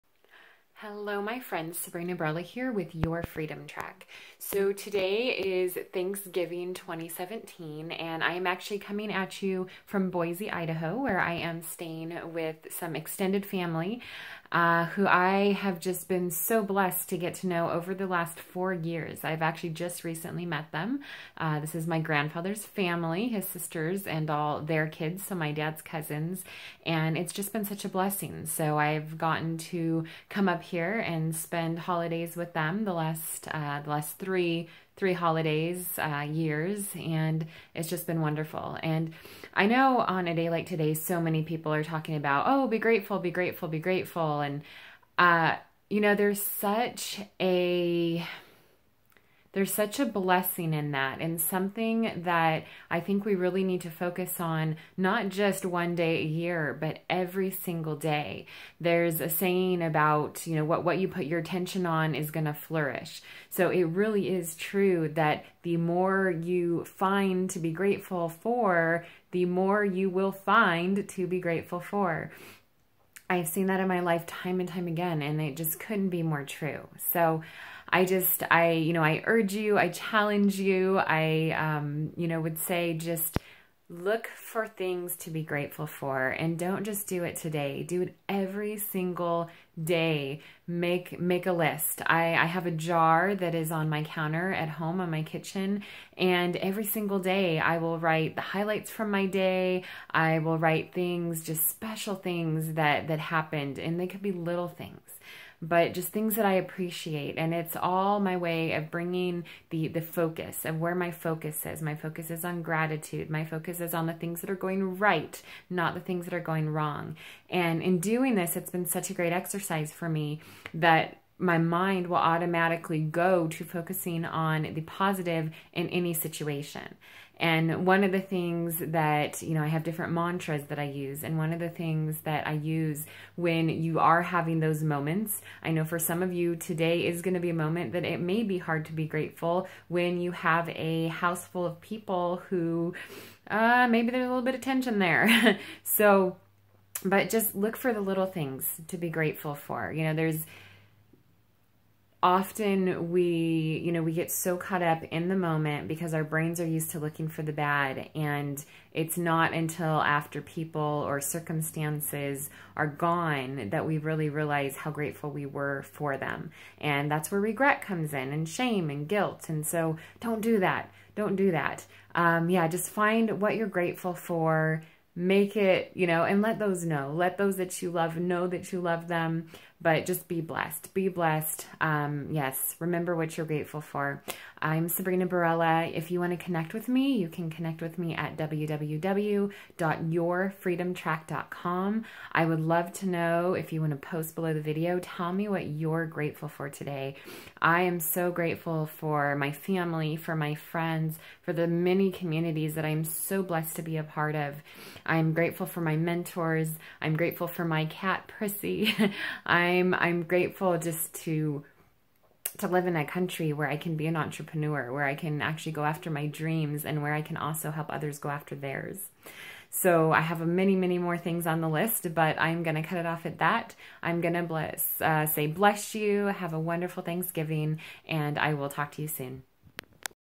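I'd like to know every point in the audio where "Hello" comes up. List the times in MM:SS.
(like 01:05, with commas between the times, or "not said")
00:00.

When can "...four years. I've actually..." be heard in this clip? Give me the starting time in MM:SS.
00:18.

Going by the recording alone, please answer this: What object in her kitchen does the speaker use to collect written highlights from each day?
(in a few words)
A jar.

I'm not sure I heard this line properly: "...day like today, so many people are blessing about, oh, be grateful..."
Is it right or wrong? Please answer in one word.
wrong.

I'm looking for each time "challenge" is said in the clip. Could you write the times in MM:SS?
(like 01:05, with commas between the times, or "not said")
01:19.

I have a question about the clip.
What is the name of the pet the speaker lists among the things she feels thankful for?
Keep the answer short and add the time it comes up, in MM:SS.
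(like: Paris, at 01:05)
Prissy, at 03:28.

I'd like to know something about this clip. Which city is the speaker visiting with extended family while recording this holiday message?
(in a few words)
Boise, Idaho.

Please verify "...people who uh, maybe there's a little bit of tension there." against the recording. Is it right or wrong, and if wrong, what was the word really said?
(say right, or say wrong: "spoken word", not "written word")
right.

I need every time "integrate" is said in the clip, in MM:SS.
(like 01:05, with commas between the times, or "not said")
not said.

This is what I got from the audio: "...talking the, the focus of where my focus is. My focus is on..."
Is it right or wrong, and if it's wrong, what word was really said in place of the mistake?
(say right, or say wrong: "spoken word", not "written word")
wrong: "bringing", not "talking".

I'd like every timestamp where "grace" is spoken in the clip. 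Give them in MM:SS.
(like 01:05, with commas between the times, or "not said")
not said.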